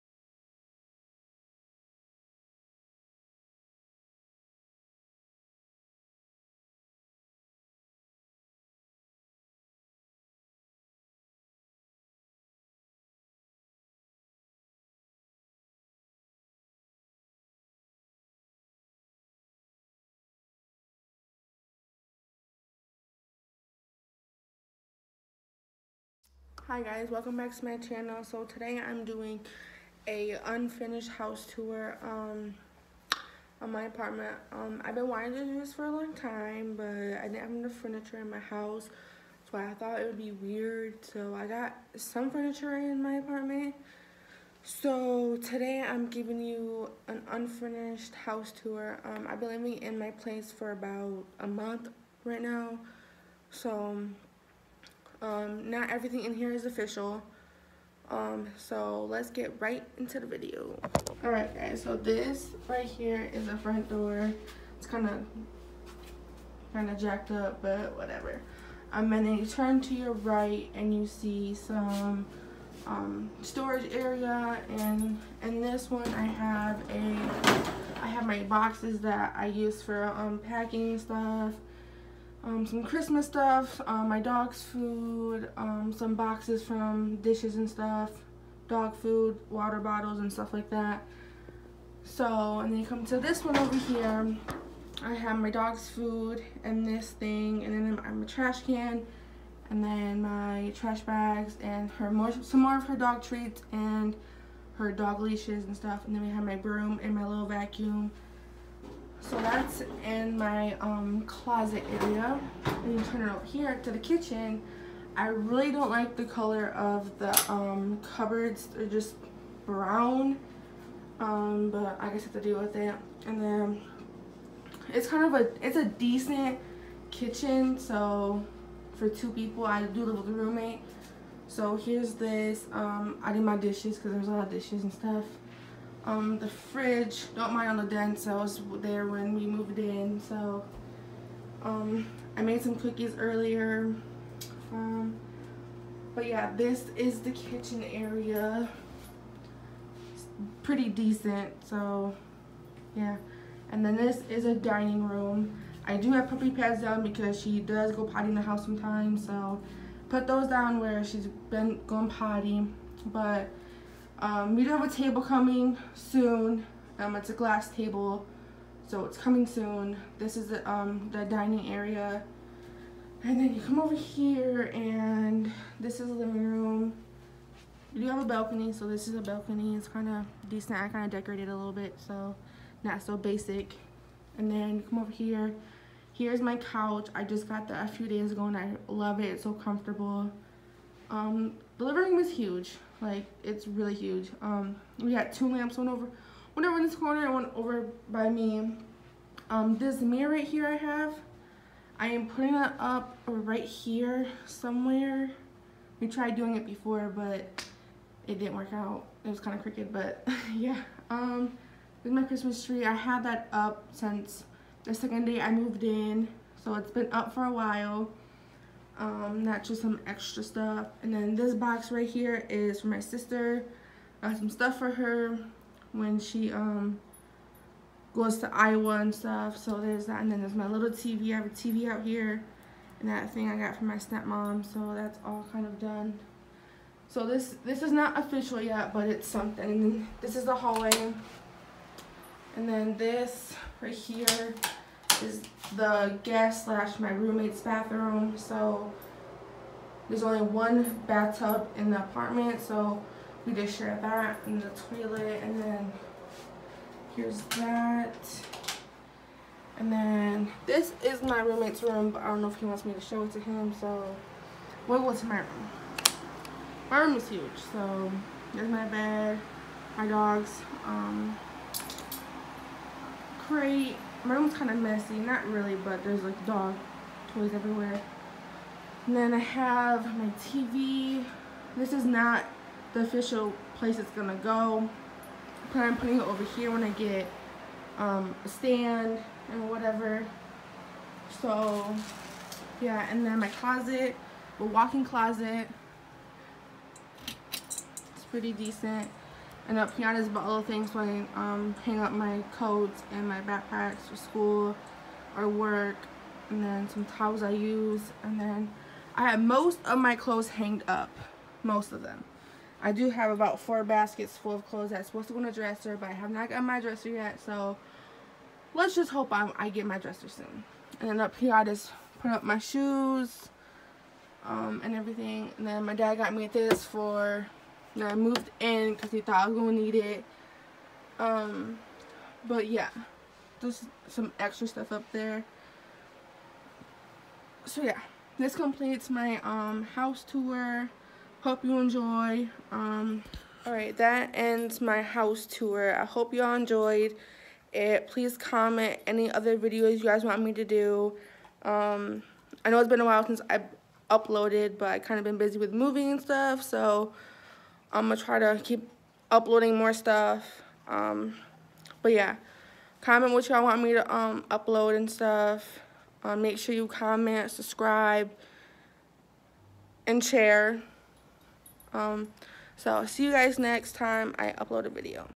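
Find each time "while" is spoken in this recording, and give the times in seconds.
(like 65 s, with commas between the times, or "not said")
217 s, 353 s.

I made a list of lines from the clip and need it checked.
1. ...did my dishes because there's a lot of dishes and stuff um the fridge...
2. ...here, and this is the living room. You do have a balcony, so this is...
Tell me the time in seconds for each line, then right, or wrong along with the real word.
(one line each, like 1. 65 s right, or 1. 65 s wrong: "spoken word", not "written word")
1. 133 s right
2. 173 s right.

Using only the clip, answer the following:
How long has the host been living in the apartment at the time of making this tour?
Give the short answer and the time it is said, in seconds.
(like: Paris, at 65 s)
About a month, at 50 s.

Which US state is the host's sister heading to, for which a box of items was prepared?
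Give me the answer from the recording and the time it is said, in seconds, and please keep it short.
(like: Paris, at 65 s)
Iowa, at 228 s.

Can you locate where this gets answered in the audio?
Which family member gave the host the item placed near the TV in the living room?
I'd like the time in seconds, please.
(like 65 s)
233 s.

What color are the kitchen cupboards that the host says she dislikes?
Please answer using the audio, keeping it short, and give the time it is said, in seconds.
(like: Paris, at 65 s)
Brown, at 119 s.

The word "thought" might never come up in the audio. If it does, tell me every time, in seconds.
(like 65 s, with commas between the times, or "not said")
39 s, 329 s.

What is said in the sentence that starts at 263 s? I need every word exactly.
So we'll go to my room.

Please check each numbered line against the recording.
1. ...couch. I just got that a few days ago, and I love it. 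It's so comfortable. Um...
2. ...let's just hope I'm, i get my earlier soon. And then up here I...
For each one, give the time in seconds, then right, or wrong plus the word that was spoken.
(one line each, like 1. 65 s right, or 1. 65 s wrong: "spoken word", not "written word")
1. 186 s right
2. 318 s wrong: "dresser", not "earlier".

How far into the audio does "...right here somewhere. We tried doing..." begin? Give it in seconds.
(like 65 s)
203 s.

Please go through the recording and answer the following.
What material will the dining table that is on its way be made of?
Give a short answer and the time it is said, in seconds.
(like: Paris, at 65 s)
Glass, at 167 s.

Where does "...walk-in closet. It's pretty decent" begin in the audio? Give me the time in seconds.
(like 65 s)
294 s.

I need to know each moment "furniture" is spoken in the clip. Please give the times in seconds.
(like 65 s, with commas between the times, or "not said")
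37 s, 42 s.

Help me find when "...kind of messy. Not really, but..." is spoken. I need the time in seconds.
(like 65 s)
274 s.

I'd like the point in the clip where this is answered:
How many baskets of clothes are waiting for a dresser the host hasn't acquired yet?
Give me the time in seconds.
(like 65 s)
313 s.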